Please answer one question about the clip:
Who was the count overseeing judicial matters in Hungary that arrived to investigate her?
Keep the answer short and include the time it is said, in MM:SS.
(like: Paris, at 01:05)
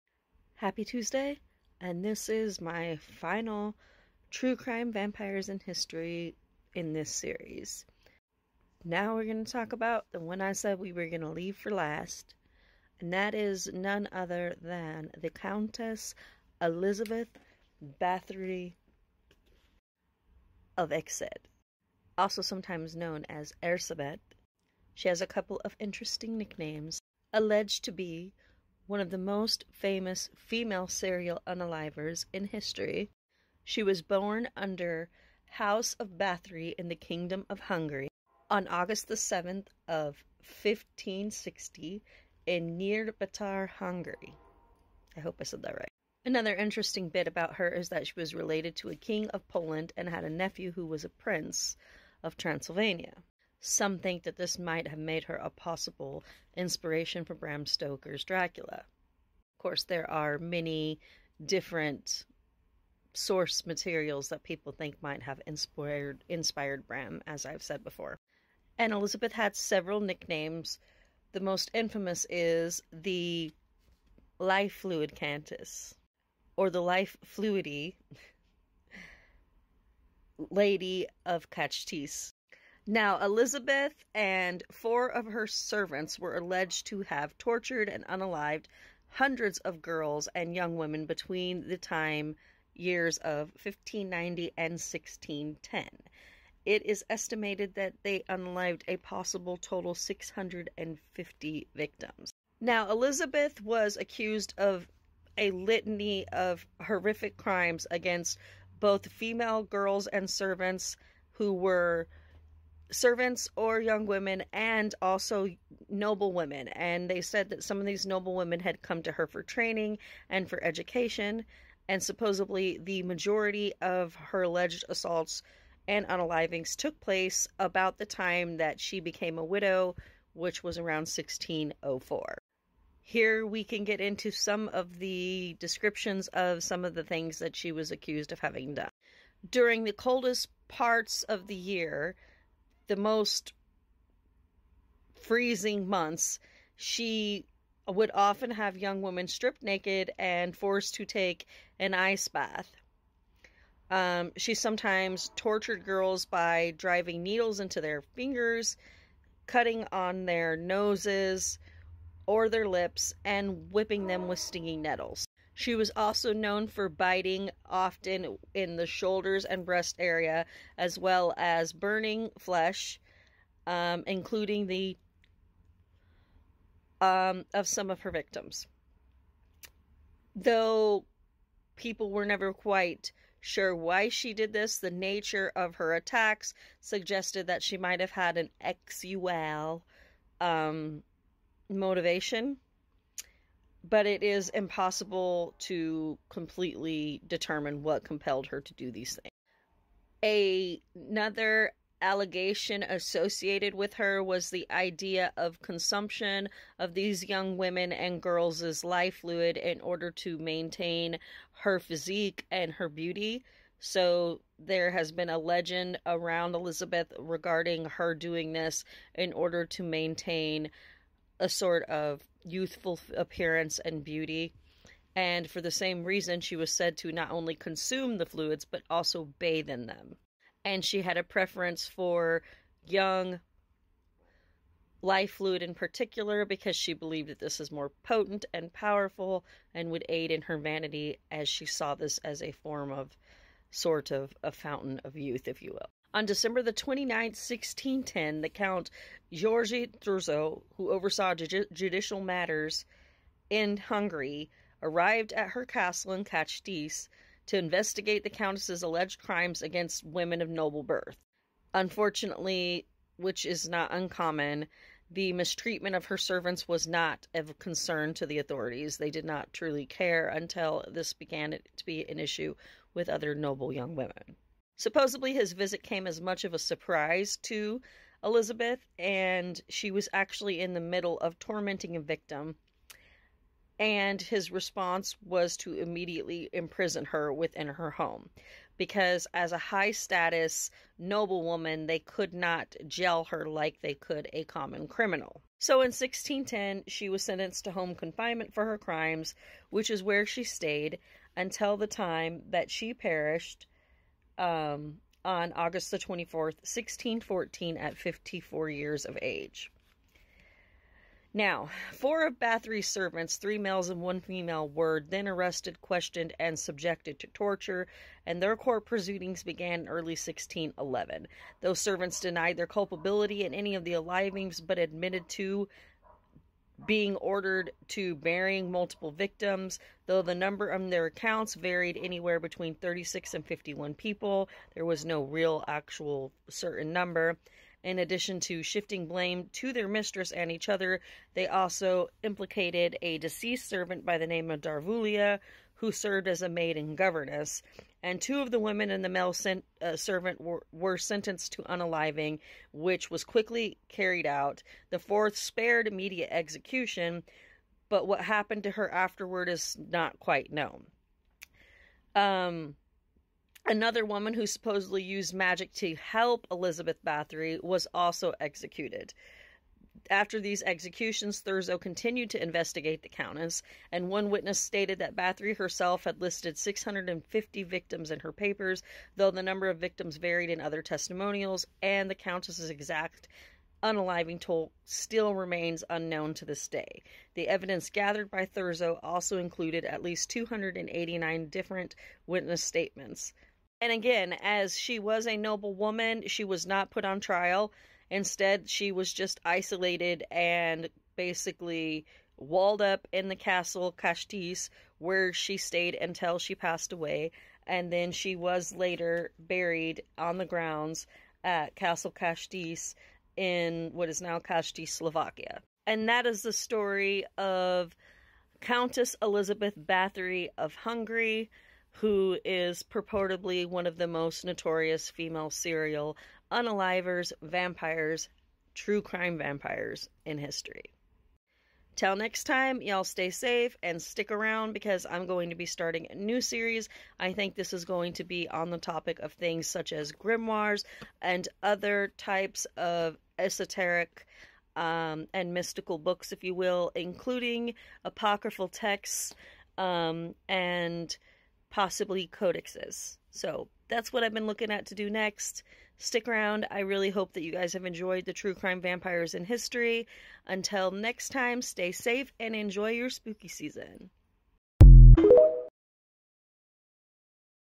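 Georgi Thurzo, at 04:09.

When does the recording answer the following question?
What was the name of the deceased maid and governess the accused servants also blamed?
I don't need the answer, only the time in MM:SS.
05:44.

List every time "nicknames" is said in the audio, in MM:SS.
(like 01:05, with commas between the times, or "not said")
00:26, 01:09.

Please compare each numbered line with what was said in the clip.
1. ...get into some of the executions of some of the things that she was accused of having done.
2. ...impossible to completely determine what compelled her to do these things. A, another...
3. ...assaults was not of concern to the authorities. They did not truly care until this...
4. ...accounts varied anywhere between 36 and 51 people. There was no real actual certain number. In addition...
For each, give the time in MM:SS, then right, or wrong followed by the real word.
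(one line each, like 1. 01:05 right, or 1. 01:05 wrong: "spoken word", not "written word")
1. 02:13 wrong: "descriptions", not "executions"
2. 03:14 right
3. 04:26 wrong: "servants", not "assaults"
4. 05:31 right.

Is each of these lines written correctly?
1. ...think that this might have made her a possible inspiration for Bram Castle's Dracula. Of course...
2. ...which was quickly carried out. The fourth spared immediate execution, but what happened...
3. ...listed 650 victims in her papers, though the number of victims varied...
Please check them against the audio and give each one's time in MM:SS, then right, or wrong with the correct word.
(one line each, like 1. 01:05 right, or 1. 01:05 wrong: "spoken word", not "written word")
1. 00:53 wrong: "Stoker", not "Castle"
2. 05:52 right
3. 06:16 right.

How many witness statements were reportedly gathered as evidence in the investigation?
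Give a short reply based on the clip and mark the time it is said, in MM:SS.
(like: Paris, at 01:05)
289, at 06:30.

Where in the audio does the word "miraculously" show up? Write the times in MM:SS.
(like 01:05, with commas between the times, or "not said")
not said.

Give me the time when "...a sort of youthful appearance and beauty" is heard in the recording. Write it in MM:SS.
03:41.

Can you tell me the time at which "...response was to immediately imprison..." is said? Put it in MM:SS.
04:44.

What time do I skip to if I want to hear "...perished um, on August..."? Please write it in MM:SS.
05:02.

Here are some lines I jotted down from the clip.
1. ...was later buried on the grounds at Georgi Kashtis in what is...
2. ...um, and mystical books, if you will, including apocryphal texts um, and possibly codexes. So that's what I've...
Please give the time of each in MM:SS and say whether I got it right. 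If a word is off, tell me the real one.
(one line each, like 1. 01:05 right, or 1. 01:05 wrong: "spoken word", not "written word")
1. 06:48 wrong: "Castle", not "Georgi"
2. 07:24 right.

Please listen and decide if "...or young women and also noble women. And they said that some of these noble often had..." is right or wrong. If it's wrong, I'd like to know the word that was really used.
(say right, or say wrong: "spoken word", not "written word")
wrong: "women", not "often".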